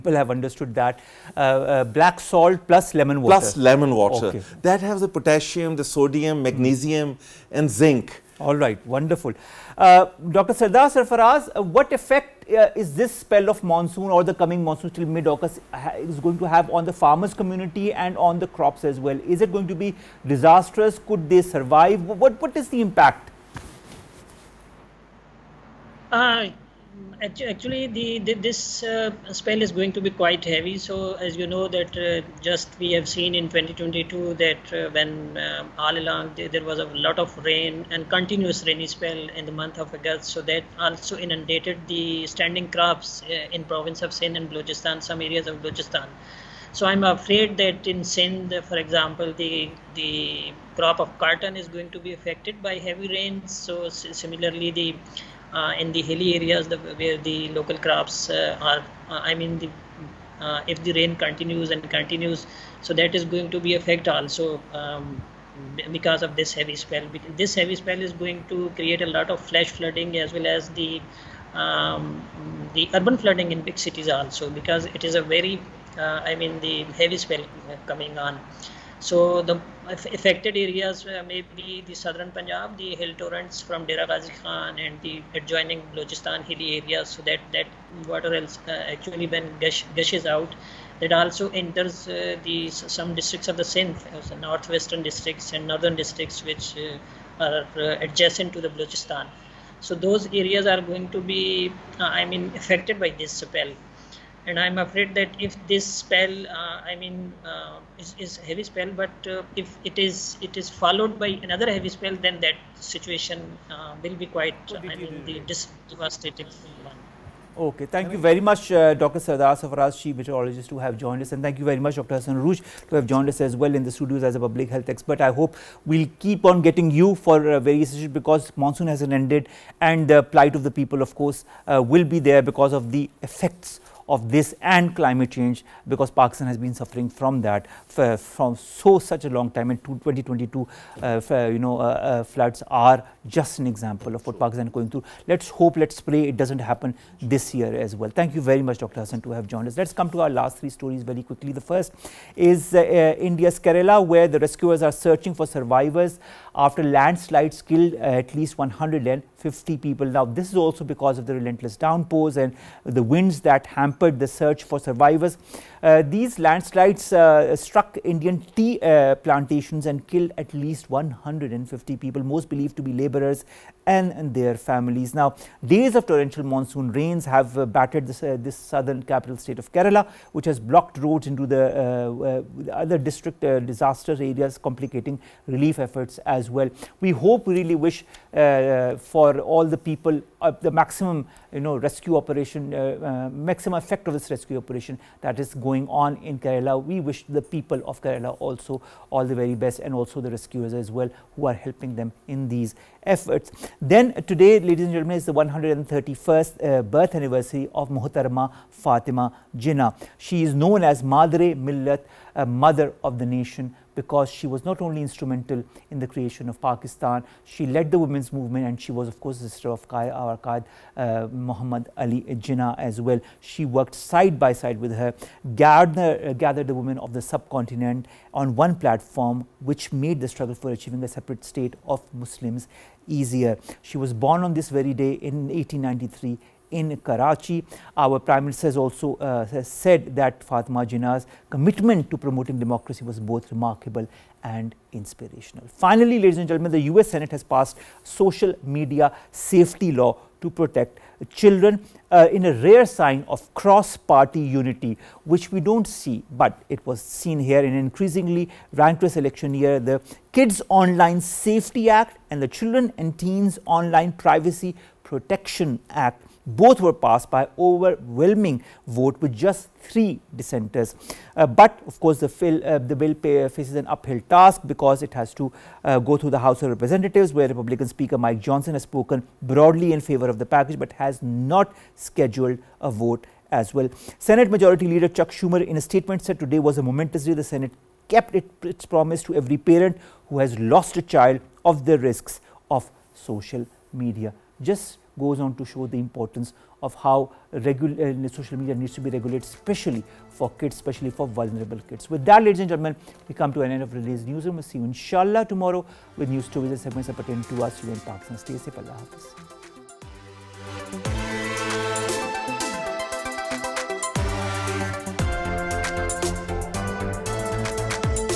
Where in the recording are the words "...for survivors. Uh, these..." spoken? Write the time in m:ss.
2:44.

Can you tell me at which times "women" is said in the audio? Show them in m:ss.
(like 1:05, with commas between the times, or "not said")
3:37, 3:46.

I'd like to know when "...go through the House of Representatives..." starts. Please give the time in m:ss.
4:35.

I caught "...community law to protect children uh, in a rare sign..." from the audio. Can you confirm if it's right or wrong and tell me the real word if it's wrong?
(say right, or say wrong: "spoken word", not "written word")
wrong: "safety", not "community".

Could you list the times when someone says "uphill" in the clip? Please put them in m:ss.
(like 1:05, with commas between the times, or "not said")
4:33.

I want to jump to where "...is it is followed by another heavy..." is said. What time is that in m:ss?
1:49.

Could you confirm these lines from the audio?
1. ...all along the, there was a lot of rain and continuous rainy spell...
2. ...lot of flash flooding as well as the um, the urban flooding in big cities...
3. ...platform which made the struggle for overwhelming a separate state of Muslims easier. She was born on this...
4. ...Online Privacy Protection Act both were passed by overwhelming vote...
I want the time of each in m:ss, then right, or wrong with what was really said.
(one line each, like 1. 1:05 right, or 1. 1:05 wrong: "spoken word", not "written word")
1. 0:35 right
2. 1:09 right
3. 3:48 wrong: "achieving", not "overwhelming"
4. 4:23 right.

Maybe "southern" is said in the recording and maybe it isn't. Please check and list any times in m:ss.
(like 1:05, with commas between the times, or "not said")
1:21, 2:58.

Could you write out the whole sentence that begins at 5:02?
With that, ladies and gentlemen, we come to an end of today's newsroom.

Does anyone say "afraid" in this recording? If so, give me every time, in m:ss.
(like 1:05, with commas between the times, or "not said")
0:47, 1:44.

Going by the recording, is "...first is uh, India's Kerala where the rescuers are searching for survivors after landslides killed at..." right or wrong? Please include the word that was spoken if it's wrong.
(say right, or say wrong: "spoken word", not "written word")
right.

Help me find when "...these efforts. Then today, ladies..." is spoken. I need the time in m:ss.
3:22.